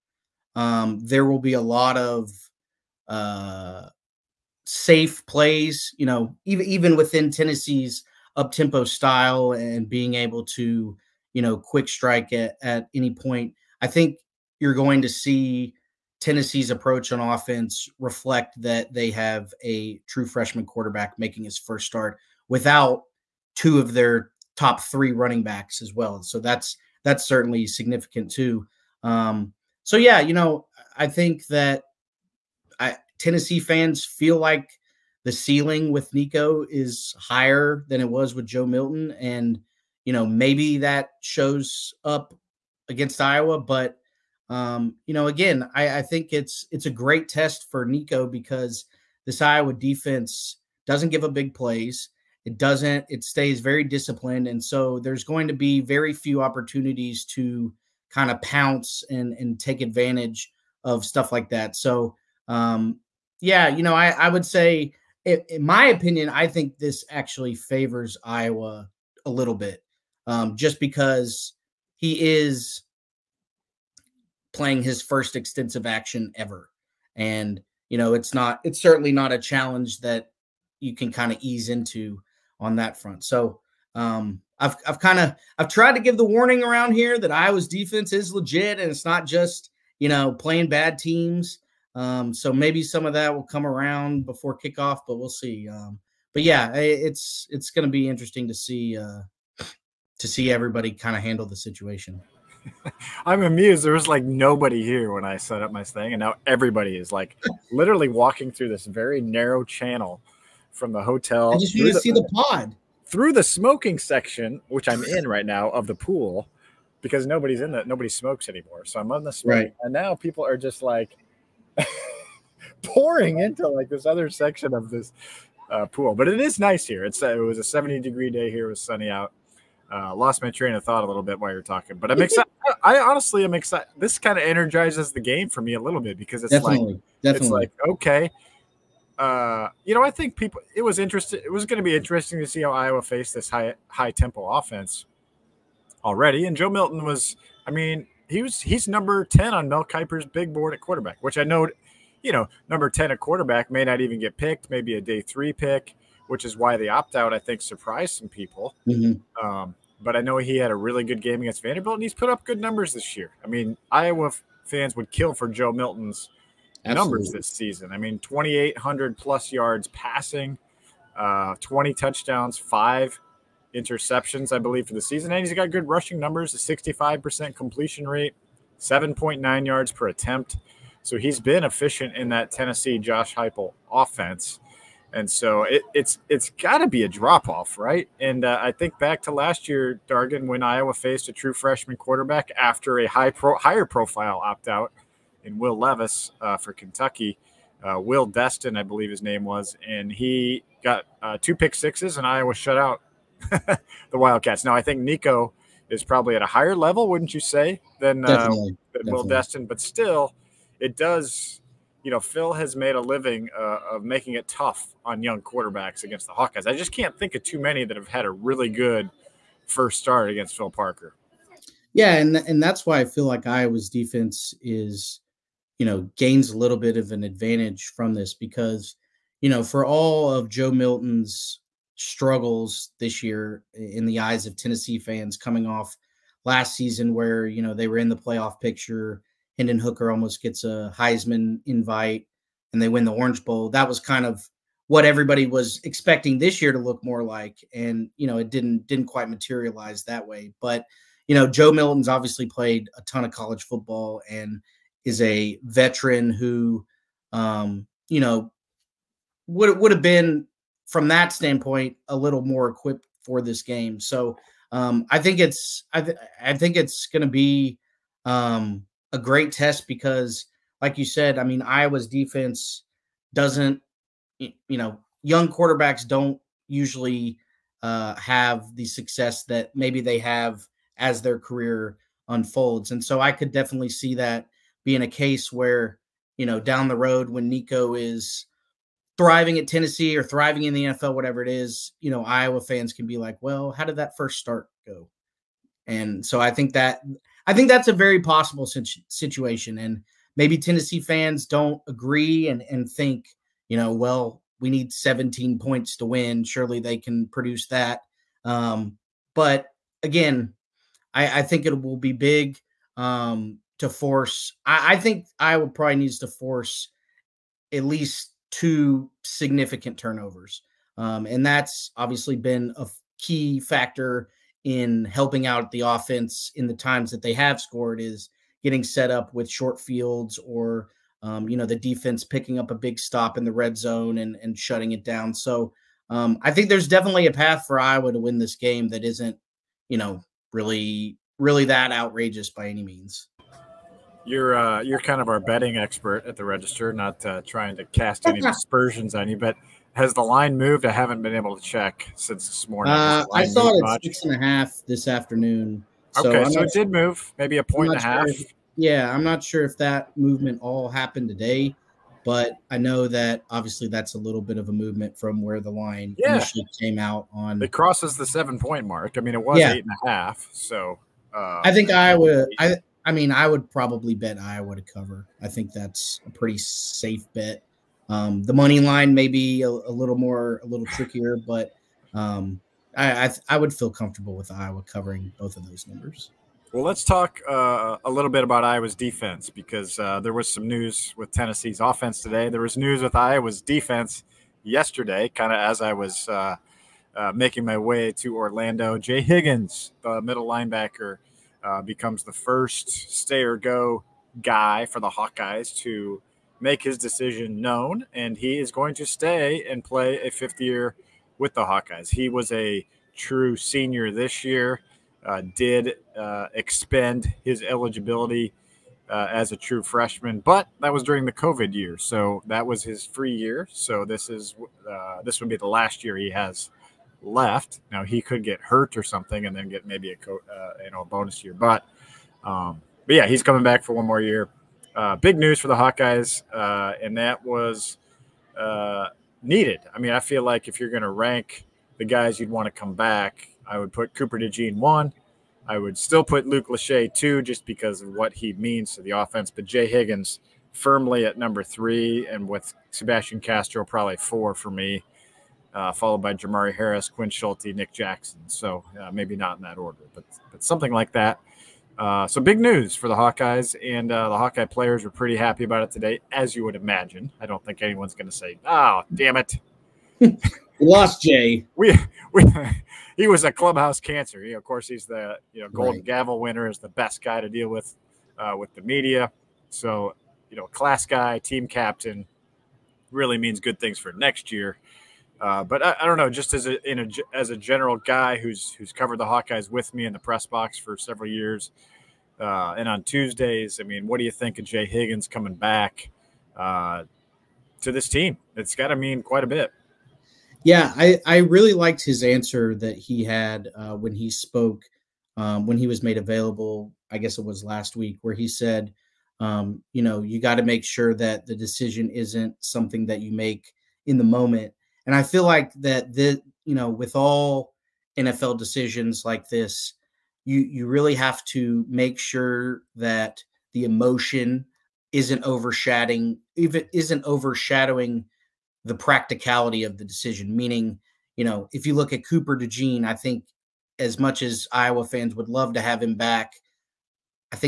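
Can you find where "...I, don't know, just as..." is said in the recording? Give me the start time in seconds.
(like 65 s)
486 s.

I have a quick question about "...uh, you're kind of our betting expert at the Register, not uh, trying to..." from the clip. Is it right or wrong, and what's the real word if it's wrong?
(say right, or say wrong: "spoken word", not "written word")
right.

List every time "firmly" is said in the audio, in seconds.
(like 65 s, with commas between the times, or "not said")
450 s.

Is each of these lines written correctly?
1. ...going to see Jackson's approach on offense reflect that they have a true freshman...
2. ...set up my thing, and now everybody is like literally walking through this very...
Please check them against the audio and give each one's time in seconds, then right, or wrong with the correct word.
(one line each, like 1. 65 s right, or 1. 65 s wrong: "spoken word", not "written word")
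1. 14 s wrong: "Tennessee", not "Jackson"
2. 105 s right.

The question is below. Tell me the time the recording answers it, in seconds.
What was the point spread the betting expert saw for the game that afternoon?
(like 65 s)
354 s.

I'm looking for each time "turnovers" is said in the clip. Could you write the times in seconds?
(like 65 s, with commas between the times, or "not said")
319 s.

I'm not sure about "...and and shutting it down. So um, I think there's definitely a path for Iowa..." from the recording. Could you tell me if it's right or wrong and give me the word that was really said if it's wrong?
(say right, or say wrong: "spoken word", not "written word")
right.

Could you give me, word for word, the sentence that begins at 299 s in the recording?
And maybe Tennessee fans don't agree and, and think, you know, well, we need 17 points to win.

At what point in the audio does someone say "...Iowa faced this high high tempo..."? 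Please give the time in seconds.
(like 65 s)
142 s.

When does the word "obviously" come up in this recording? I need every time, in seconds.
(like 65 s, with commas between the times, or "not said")
252 s, 321 s, 363 s.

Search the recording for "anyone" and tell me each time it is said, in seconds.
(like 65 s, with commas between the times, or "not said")
467 s.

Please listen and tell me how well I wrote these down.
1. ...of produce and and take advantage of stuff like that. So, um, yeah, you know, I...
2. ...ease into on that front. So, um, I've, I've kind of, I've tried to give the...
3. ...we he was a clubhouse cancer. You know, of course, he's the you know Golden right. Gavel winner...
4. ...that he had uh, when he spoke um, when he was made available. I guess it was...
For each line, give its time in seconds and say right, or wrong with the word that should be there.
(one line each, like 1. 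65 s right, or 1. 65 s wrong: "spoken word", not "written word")
1. 58 s wrong: "pounce", not "produce"
2. 81 s right
3. 472 s right
4. 502 s right.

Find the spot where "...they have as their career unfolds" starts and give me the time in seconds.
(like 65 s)
280 s.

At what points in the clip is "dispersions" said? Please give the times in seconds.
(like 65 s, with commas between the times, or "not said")
348 s.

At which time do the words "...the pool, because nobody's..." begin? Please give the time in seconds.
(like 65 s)
115 s.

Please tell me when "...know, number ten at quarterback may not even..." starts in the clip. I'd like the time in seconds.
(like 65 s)
152 s.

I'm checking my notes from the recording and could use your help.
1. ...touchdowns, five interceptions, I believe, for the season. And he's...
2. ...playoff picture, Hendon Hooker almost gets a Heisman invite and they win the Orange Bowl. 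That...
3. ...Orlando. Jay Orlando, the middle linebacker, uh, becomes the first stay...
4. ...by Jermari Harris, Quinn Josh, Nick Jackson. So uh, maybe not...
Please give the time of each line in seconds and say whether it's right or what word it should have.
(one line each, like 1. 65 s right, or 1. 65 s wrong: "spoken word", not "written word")
1. 171 s right
2. 238 s right
3. 398 s wrong: "Higgins", not "Orlando"
4. 456 s wrong: "Schulte", not "Josh".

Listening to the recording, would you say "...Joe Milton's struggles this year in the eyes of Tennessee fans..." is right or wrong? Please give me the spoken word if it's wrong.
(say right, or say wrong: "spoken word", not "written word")
right.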